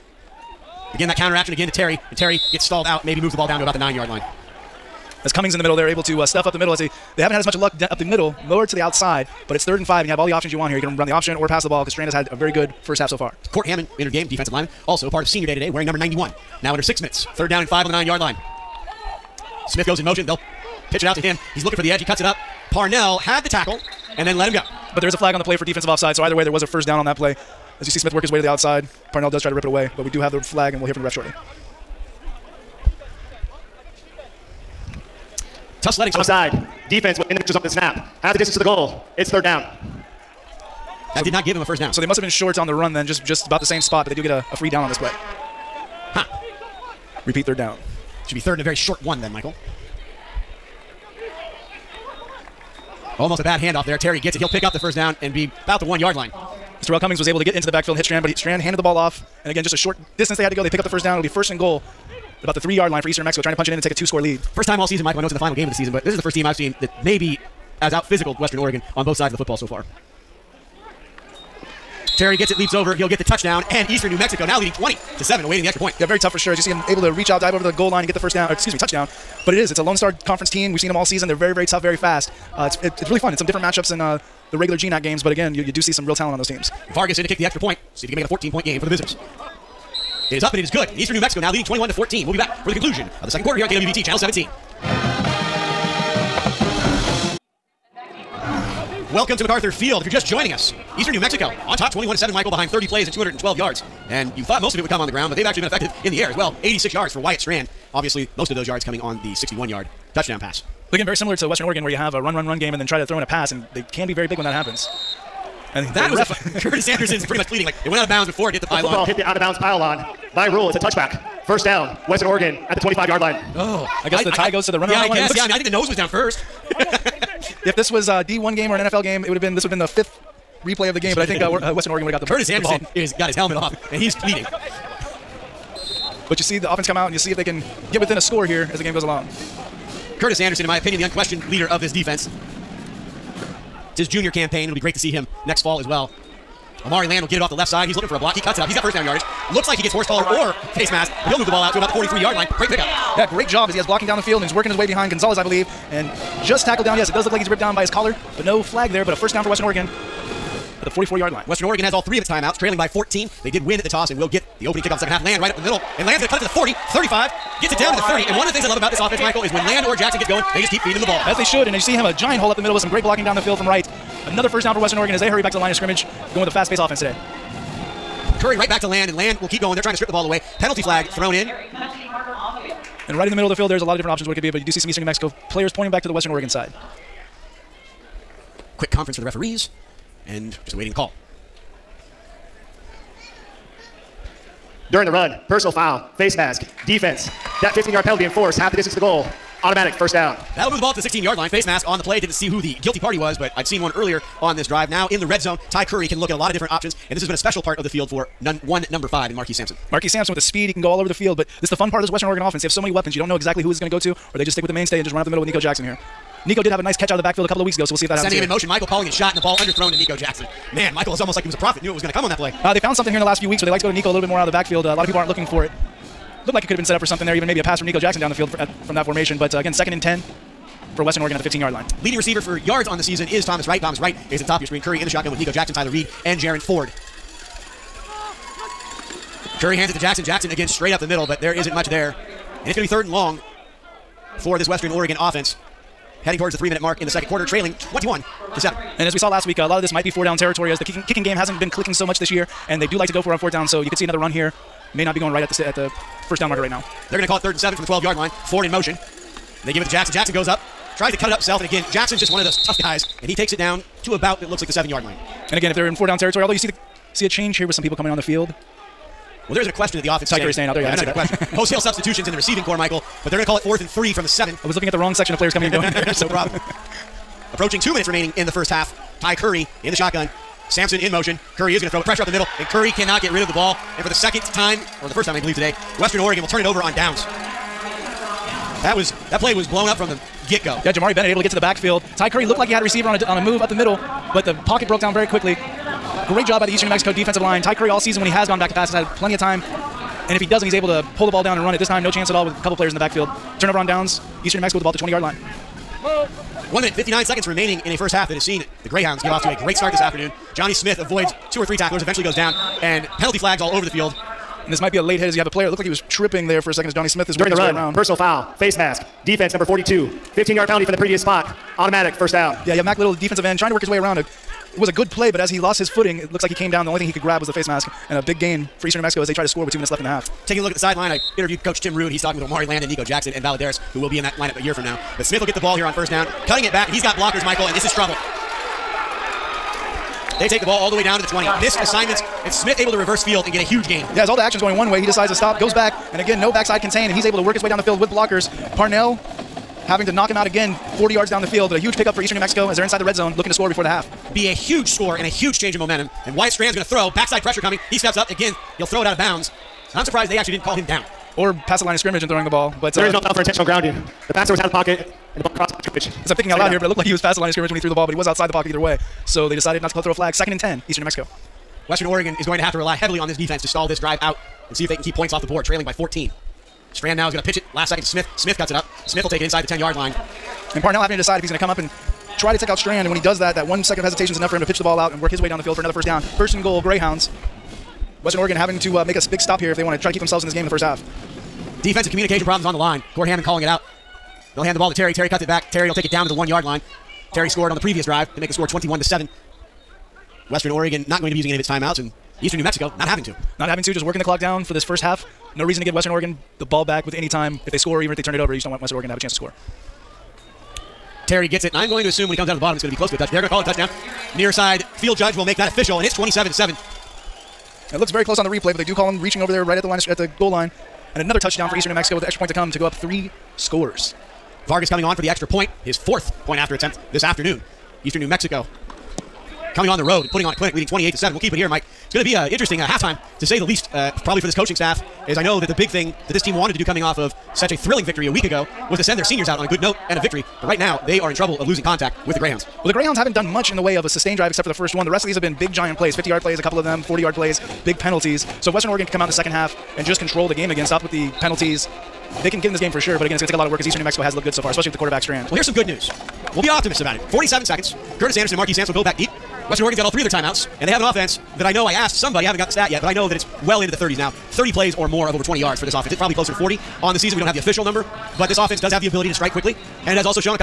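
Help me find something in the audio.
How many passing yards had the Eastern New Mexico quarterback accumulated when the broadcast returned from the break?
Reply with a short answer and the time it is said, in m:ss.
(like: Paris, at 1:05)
86, at 1:46.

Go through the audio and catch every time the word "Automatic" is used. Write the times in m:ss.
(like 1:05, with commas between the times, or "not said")
3:19, 5:21.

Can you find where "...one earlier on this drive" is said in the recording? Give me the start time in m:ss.
3:23.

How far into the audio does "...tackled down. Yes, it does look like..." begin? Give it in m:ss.
2:36.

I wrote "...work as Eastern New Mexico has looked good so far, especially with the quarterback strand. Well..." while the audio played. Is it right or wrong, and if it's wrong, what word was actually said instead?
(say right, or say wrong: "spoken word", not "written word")
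right.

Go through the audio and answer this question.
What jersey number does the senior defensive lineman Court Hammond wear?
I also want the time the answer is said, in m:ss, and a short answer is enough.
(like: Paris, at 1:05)
91, at 0:15.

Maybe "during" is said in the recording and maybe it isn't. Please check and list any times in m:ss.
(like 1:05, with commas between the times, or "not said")
3:14, 5:17.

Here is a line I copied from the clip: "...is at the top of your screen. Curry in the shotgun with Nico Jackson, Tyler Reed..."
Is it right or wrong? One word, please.
right.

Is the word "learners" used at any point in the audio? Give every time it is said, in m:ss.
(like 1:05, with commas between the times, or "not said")
not said.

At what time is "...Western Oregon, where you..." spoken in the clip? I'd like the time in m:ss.
1:51.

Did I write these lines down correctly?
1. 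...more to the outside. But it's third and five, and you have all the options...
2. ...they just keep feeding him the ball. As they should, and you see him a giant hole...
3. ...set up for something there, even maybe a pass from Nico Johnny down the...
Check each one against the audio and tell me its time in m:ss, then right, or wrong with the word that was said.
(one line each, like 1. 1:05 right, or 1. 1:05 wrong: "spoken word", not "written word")
1. 0:08 right
2. 2:50 right
3. 3:46 wrong: "Jackson", not "Johnny".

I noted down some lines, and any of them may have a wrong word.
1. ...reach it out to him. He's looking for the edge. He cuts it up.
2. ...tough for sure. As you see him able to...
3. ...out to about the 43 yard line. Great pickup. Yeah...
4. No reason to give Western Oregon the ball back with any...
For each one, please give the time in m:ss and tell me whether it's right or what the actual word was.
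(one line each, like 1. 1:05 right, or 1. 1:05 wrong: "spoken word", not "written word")
1. 0:20 wrong: "pitch", not "reach"
2. 1:16 right
3. 2:31 right
4. 6:45 right.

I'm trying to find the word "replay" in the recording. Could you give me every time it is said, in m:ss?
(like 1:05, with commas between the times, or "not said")
2:10, 6:58.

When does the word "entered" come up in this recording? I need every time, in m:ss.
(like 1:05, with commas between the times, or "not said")
0:13.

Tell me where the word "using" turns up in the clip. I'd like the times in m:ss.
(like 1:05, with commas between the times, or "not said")
6:41.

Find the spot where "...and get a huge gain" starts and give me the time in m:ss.
5:43.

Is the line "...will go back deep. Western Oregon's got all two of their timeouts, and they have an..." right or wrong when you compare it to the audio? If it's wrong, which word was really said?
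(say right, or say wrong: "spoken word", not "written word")
wrong: "three", not "two".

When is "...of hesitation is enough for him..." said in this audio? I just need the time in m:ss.
6:23.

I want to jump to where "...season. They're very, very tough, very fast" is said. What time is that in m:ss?
1:21.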